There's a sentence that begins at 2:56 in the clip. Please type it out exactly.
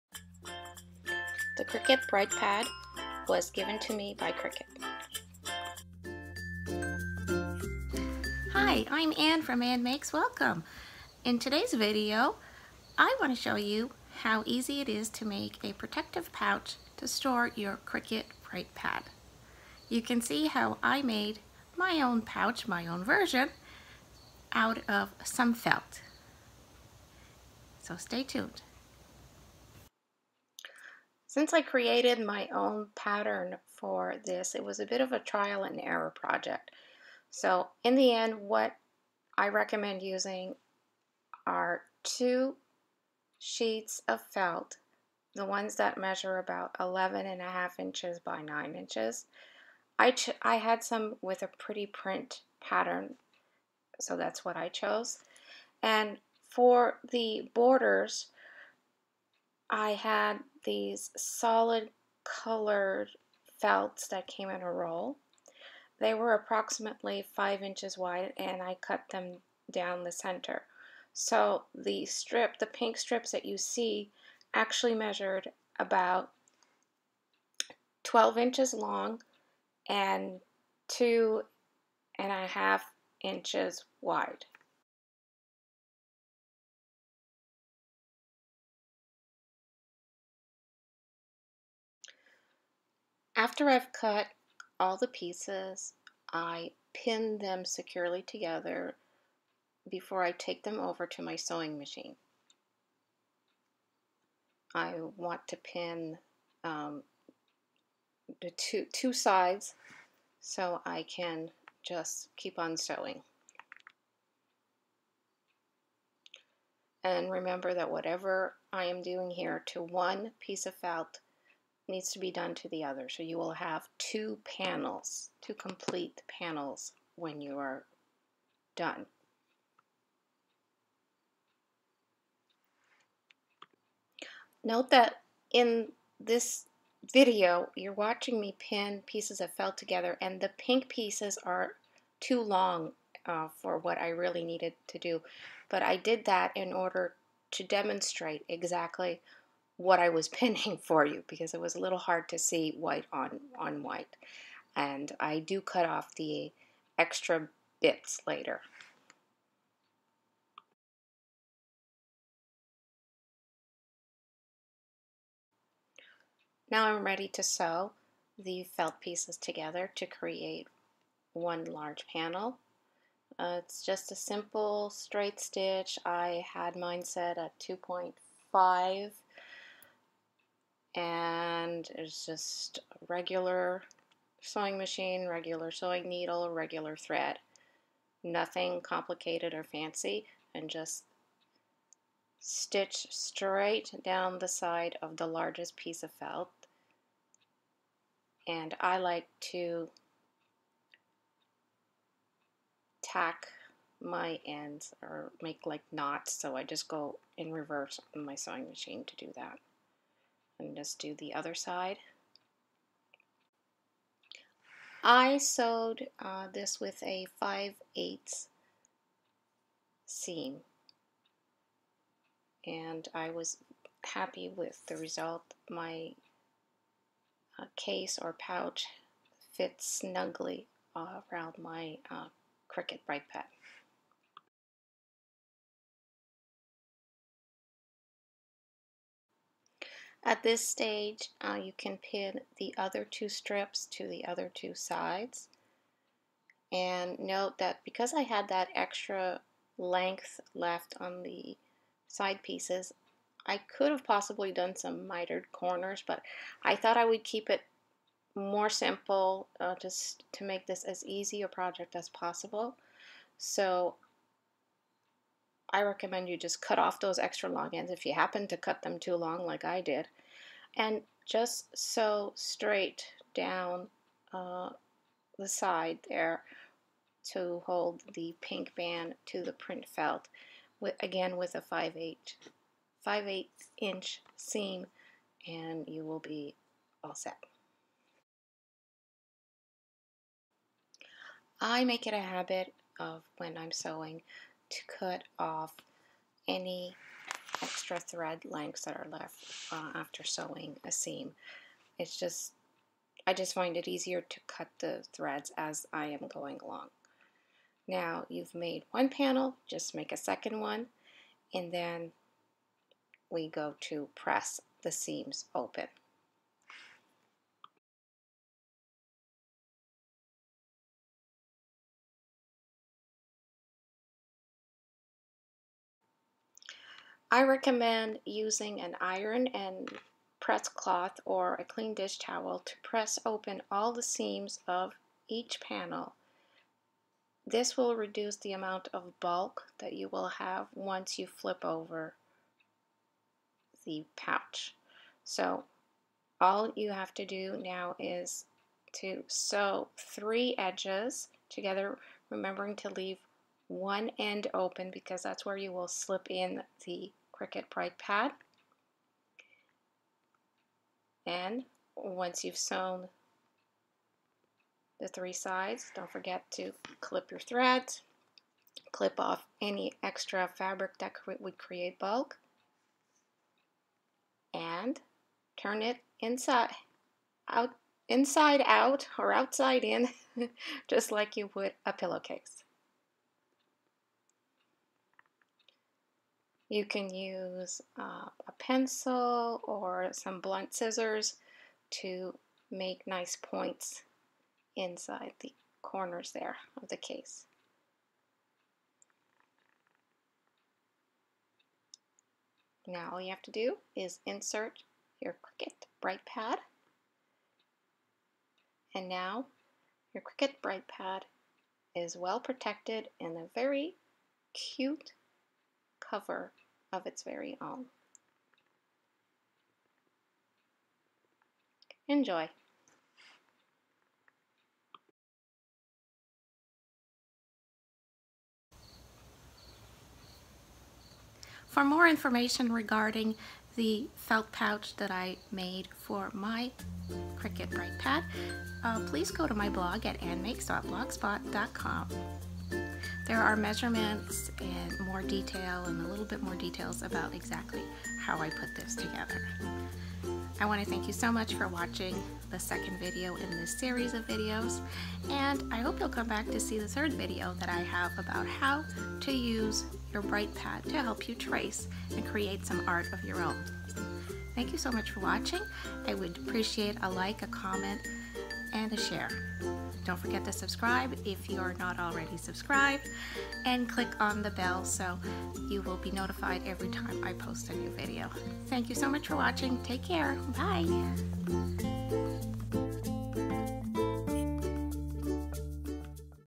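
I had mine set at 2.5 and it's just regular sewing machine, regular sewing needle, regular thread.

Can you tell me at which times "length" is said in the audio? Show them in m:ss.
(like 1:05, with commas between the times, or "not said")
4:09, 4:58.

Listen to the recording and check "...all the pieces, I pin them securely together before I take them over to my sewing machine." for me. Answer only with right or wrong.
right.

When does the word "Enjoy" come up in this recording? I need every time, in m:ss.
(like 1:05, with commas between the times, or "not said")
7:02.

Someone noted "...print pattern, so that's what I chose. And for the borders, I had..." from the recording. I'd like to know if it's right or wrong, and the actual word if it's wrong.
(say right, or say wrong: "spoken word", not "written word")
right.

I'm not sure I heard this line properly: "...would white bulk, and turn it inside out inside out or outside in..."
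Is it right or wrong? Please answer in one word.
wrong.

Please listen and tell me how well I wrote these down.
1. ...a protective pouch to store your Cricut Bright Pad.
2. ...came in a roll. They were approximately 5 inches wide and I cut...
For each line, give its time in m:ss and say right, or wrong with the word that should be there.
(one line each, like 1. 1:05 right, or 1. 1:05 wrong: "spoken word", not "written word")
1. 0:15 right
2. 1:04 right.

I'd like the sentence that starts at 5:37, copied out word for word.
This will reduce the amount of bulk that you will have once you flip over the pouch.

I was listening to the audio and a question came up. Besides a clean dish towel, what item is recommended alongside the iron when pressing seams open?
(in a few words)
Press cloth.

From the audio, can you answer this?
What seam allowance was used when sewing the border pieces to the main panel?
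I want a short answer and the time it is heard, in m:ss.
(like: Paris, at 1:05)
5/8 inch, at 3:37.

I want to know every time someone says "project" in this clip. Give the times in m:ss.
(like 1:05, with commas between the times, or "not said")
0:36, 4:21.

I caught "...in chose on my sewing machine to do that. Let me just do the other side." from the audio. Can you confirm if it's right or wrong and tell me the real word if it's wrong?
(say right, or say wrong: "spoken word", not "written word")
wrong: "reverse", not "chose".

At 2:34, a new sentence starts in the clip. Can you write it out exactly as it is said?
And I do cut off the extra bits later.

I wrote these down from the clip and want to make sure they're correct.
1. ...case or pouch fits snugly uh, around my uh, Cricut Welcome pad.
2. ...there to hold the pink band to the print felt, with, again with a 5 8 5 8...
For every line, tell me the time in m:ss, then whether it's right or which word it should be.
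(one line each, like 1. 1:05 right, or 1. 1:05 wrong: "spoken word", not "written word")
1. 3:47 wrong: "Bright", not "Welcome"
2. 4:36 right.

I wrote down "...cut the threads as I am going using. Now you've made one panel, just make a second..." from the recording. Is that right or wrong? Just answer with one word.
wrong.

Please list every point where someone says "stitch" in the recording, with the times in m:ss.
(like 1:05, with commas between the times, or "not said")
2:55, 3:12.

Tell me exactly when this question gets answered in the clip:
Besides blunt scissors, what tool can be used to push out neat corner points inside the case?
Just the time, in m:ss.
6:28.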